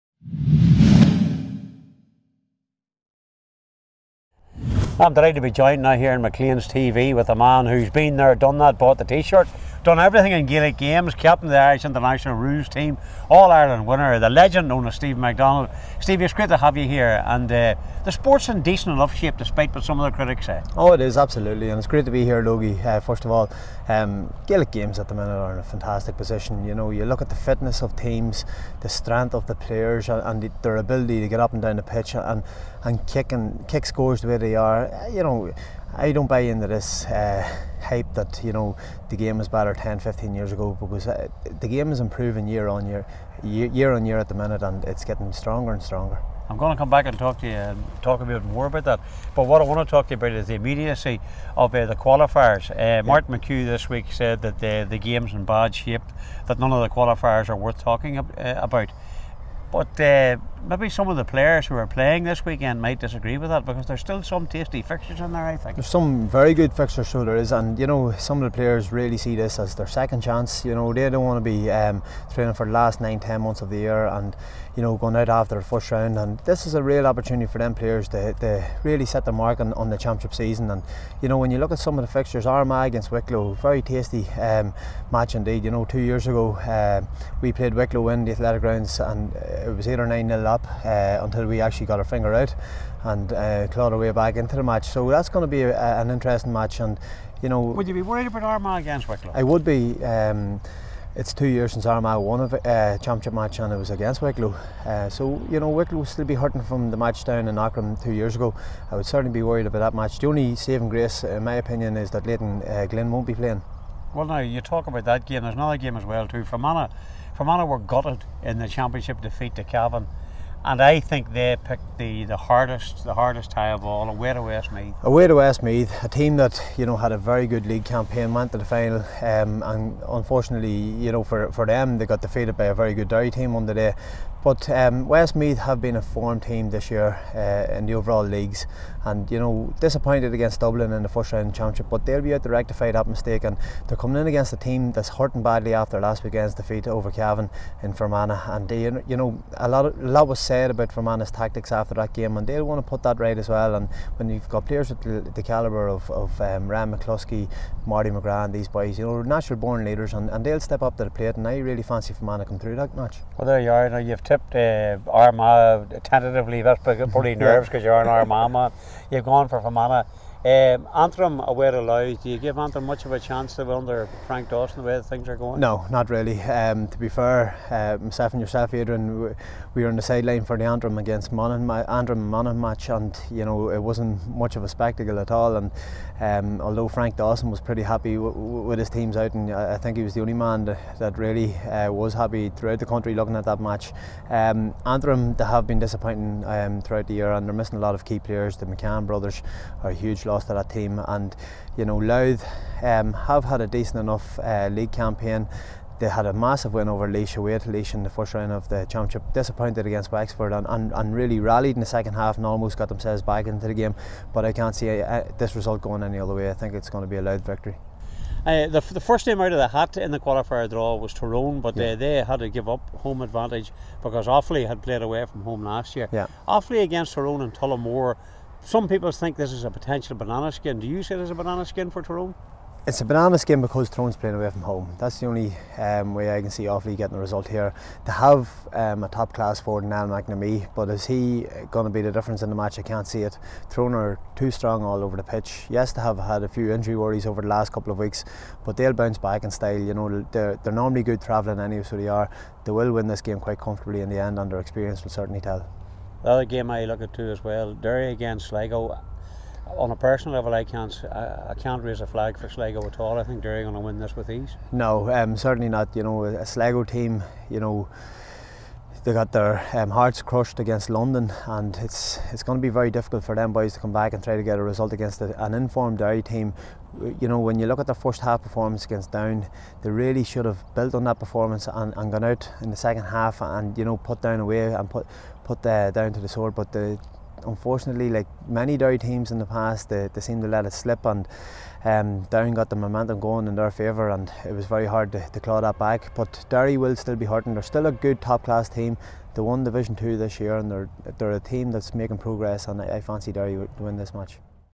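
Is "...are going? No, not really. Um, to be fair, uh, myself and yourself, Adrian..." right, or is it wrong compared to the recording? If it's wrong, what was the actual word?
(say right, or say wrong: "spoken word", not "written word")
right.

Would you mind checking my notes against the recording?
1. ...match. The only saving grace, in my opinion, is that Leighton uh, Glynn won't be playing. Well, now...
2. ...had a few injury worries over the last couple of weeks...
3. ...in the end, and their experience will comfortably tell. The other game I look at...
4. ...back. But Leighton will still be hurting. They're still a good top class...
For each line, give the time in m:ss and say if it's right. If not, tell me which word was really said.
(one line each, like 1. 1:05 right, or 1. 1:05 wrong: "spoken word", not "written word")
1. 1:49 right
2. 4:06 right
3. 4:14 wrong: "certainly", not "comfortably"
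4. 4:55 wrong: "Derry", not "Leighton".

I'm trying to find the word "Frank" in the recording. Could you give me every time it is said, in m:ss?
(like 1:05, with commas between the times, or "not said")
2:54, 3:06.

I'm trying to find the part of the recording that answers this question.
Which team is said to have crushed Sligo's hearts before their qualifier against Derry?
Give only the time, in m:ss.
4:30.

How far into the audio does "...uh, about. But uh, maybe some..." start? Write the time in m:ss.
0:58.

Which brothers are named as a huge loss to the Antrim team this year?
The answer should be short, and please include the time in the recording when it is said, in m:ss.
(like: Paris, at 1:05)
The McCann brothers, at 3:18.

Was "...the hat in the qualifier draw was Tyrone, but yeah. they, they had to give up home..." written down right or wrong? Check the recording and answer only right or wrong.
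right.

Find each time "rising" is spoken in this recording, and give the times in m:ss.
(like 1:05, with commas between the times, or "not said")
not said.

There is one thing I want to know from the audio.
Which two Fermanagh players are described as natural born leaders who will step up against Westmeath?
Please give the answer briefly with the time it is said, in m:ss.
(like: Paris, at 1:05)
Ryan McCluskey, Marty McGrath, at 2:36.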